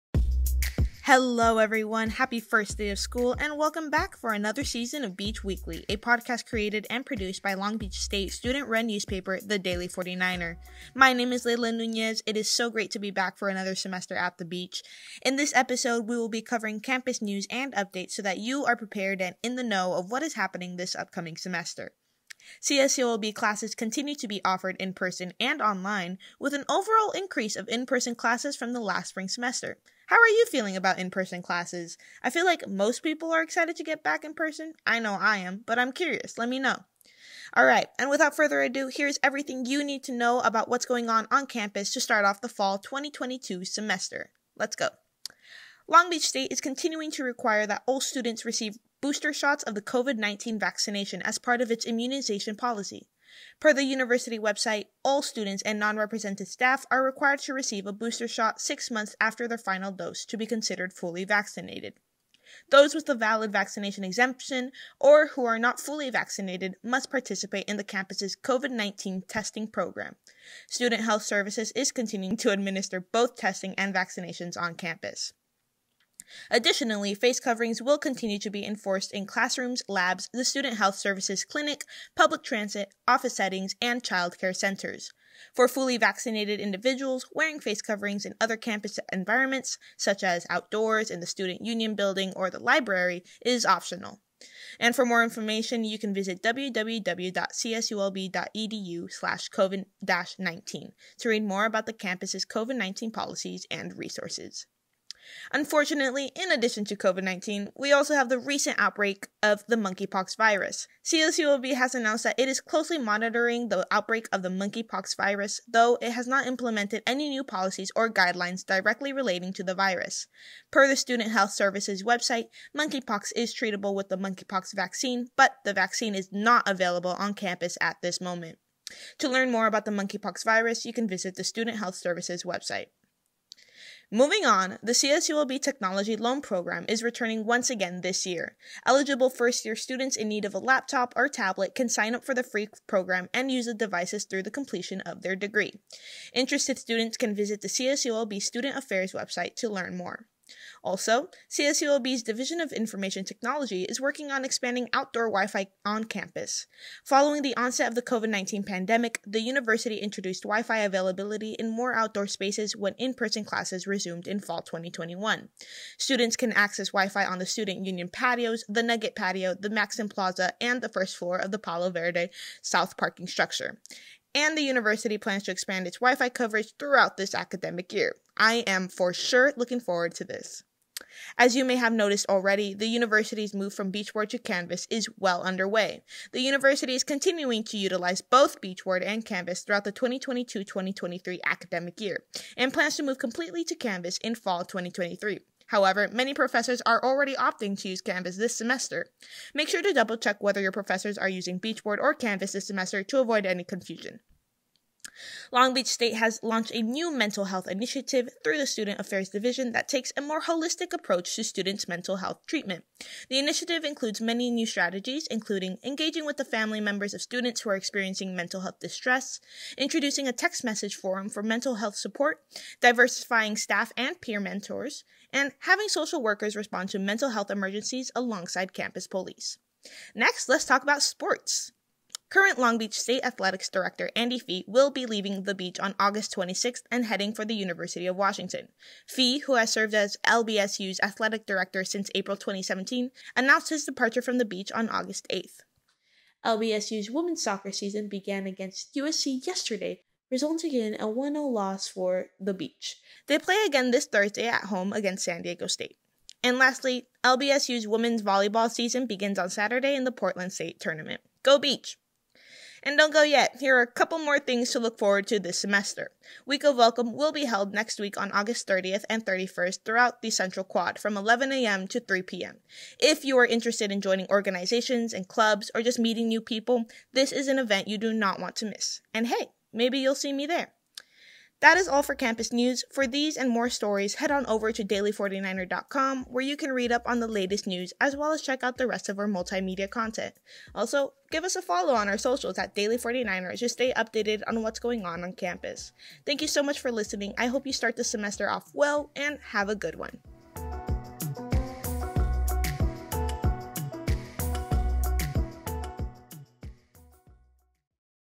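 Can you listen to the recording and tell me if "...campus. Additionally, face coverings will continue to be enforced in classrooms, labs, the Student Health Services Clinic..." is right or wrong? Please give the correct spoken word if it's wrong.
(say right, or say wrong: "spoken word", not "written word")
right.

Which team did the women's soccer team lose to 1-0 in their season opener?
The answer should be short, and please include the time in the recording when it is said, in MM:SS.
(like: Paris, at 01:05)
USC, at 04:08.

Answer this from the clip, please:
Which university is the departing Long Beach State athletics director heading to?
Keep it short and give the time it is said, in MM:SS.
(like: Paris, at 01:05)
University of Washington, at 03:57.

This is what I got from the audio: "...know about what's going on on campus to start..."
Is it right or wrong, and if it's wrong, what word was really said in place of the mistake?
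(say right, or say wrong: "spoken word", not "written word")
right.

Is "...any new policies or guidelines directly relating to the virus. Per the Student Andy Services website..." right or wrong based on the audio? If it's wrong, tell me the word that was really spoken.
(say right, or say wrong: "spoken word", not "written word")
wrong: "Health", not "Andy".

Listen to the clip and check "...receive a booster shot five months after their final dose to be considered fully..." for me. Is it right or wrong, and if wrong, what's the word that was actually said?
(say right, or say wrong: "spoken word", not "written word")
wrong: "six", not "five".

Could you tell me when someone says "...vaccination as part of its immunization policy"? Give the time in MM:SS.
00:50.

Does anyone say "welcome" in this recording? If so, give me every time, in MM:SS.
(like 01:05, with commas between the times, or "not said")
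00:03, 04:26.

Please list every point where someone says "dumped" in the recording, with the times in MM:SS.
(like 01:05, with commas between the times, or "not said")
not said.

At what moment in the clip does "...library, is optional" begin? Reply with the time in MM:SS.
01:32.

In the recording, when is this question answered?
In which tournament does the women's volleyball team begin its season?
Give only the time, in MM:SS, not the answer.
04:20.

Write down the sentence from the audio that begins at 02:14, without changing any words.
Moving on, the CSULB Technology Loan Program is returning once again this year.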